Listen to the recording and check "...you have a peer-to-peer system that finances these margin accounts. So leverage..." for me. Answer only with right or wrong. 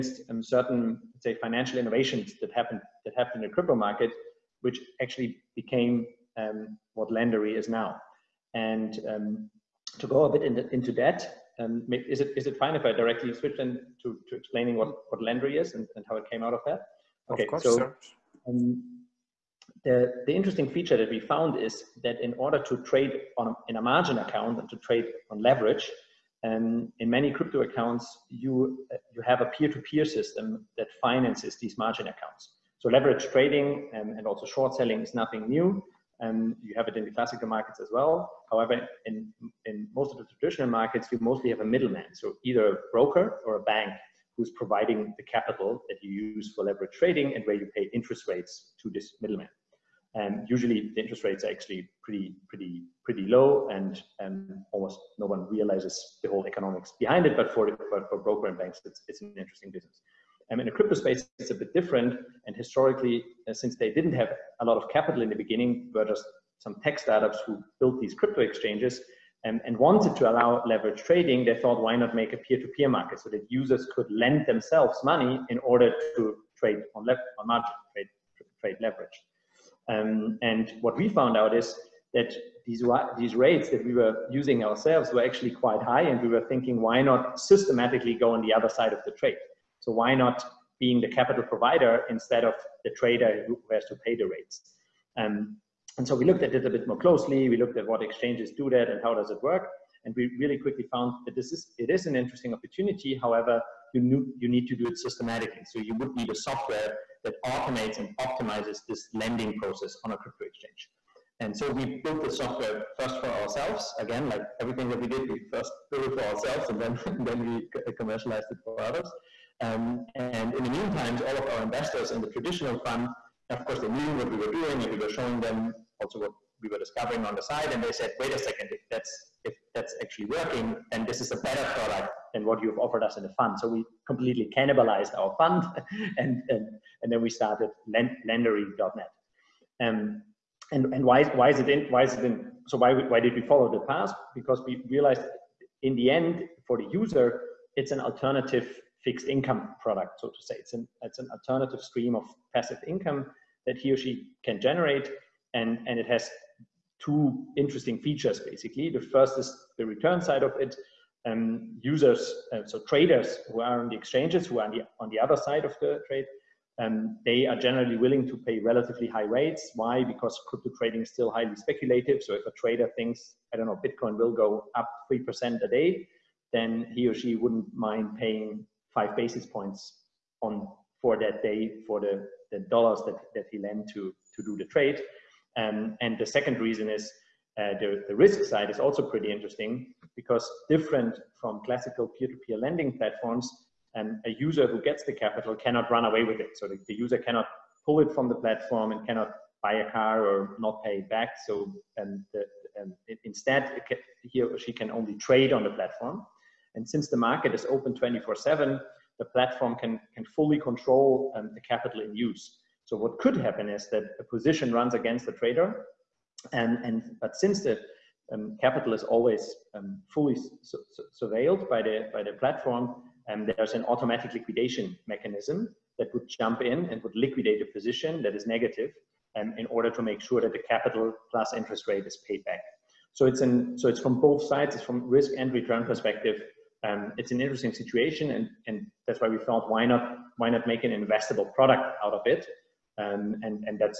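right.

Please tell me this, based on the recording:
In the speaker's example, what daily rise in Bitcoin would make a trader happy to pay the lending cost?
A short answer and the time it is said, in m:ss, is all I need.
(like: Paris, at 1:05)
3%, at 2:55.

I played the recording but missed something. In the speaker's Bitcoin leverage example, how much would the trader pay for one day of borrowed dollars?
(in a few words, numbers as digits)
5 basis points.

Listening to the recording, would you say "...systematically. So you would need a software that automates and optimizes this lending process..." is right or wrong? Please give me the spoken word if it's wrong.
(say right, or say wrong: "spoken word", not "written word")
right.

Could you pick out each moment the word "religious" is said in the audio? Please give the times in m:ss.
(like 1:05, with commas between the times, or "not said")
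not said.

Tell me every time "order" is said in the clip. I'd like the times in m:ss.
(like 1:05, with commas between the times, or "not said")
0:22, 1:15, 3:49.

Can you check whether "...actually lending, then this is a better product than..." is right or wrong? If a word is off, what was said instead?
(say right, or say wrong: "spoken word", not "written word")
wrong: "working", not "lending".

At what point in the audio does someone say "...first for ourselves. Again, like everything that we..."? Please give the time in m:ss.
1:52.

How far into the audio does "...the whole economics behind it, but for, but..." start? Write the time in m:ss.
0:56.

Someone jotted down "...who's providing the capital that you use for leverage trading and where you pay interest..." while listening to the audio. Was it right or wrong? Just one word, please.
right.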